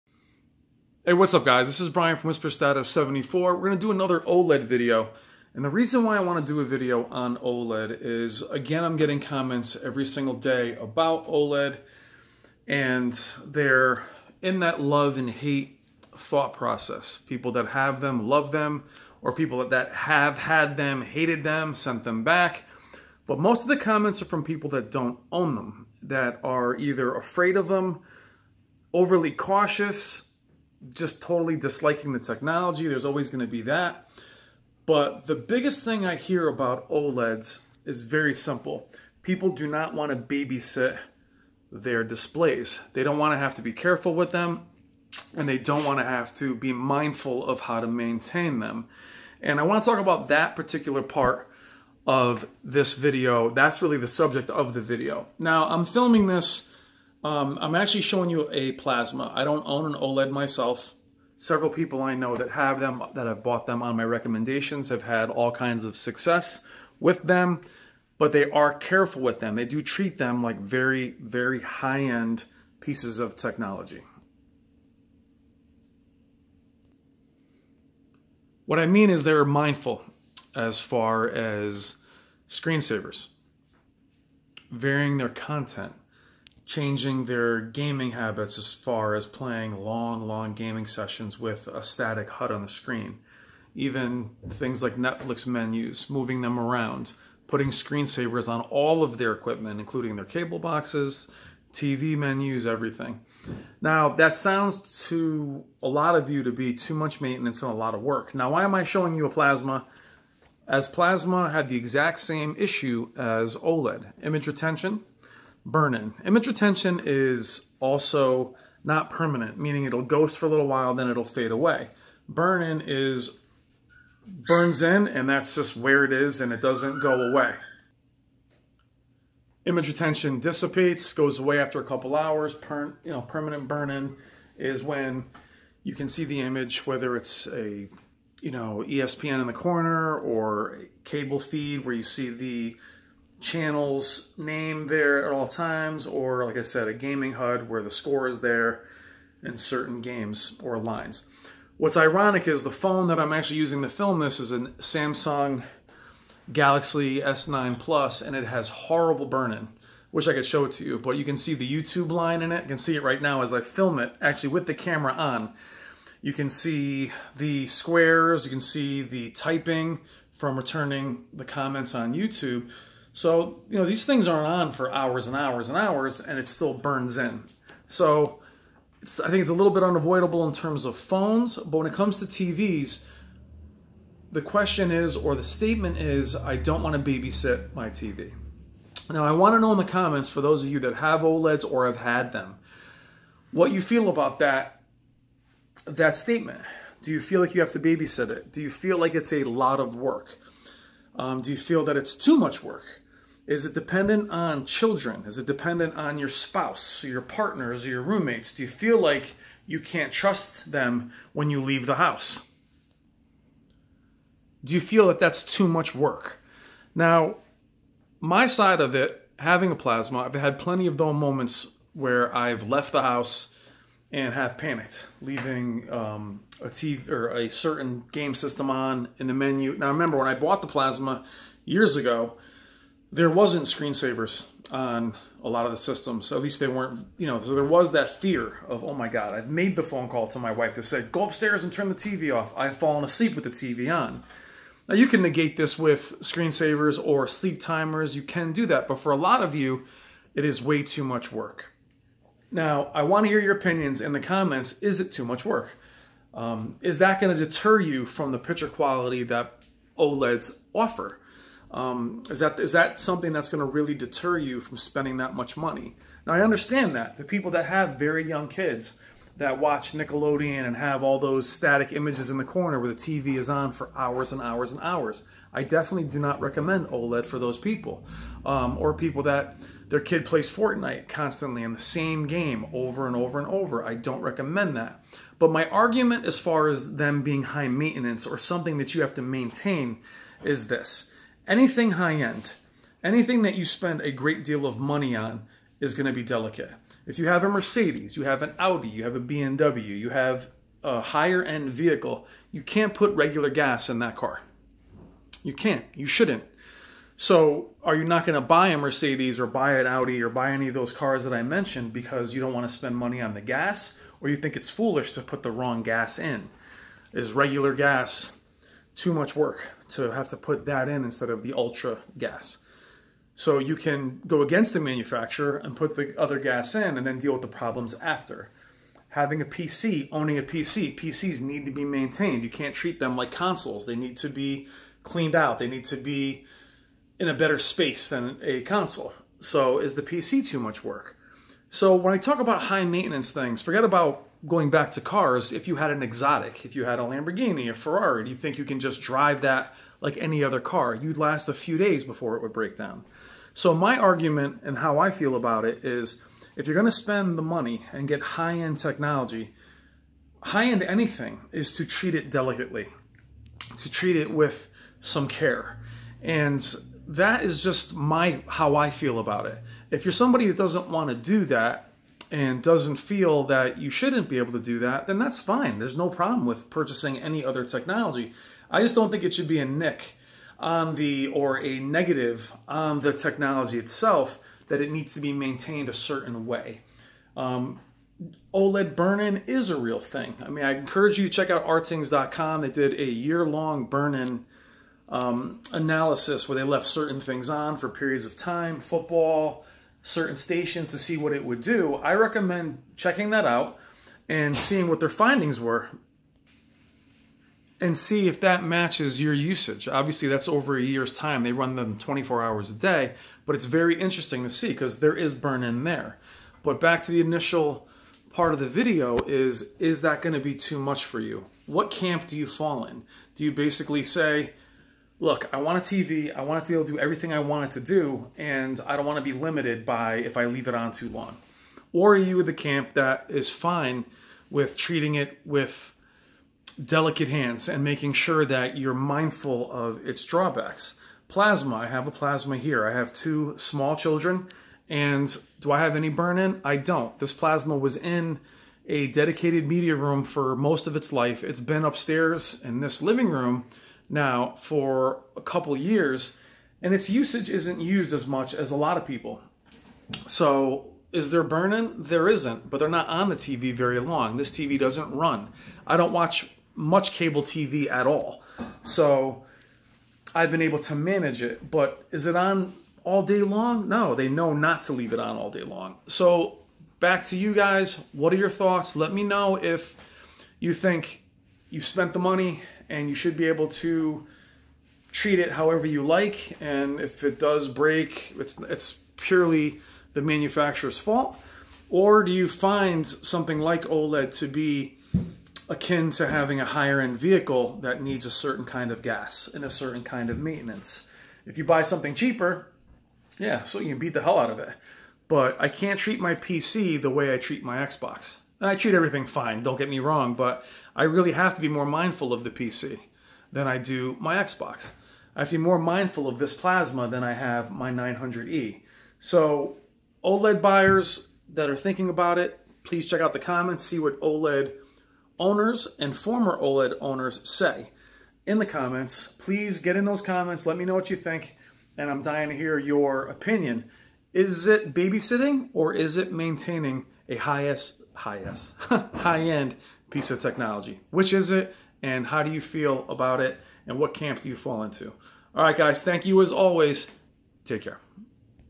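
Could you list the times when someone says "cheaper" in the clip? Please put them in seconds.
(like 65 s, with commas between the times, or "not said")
502 s.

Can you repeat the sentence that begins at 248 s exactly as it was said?
You can do that, but for a lot of you, it is way too much work.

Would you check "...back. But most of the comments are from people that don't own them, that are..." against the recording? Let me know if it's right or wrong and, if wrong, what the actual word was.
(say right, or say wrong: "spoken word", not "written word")
right.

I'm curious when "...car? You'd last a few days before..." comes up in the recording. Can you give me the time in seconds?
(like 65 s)
350 s.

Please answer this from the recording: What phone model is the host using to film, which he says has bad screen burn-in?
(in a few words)
Samsung Galaxy S9 Plus.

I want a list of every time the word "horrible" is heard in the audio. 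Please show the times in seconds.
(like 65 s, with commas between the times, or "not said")
158 s.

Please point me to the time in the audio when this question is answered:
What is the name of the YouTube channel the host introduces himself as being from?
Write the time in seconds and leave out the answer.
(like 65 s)
2 s.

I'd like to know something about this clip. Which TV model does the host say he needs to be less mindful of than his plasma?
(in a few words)
900E.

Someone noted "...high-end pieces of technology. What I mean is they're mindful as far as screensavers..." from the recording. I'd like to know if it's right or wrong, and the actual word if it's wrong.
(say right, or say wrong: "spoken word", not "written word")
right.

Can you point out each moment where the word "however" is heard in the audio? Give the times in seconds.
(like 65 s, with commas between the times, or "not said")
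485 s.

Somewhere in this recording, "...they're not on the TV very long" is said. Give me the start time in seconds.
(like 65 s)
462 s.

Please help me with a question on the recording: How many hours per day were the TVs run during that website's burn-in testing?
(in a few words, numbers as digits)
24.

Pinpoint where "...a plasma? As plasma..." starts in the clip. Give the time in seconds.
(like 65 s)
109 s.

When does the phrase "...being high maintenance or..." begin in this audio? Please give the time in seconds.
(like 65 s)
287 s.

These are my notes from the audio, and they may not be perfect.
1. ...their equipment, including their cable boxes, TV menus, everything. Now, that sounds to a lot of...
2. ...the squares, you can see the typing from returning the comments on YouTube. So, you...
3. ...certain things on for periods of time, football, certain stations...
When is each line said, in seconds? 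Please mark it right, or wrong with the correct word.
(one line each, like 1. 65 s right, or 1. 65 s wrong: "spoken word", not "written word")
1. 99 s right
2. 167 s right
3. 396 s right.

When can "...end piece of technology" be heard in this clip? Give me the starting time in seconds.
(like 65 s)
539 s.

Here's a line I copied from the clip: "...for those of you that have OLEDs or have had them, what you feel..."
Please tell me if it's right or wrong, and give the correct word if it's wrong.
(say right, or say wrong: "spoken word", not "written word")
right.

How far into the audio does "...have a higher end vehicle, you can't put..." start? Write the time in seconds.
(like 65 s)
300 s.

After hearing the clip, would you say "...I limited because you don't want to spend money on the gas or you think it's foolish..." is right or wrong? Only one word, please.
wrong.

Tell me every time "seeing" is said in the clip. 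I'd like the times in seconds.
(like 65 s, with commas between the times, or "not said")
404 s.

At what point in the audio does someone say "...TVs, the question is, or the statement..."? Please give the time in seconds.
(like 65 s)
182 s.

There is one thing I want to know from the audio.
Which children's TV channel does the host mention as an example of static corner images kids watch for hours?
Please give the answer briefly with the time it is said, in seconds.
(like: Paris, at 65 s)
Nickelodeon, at 269 s.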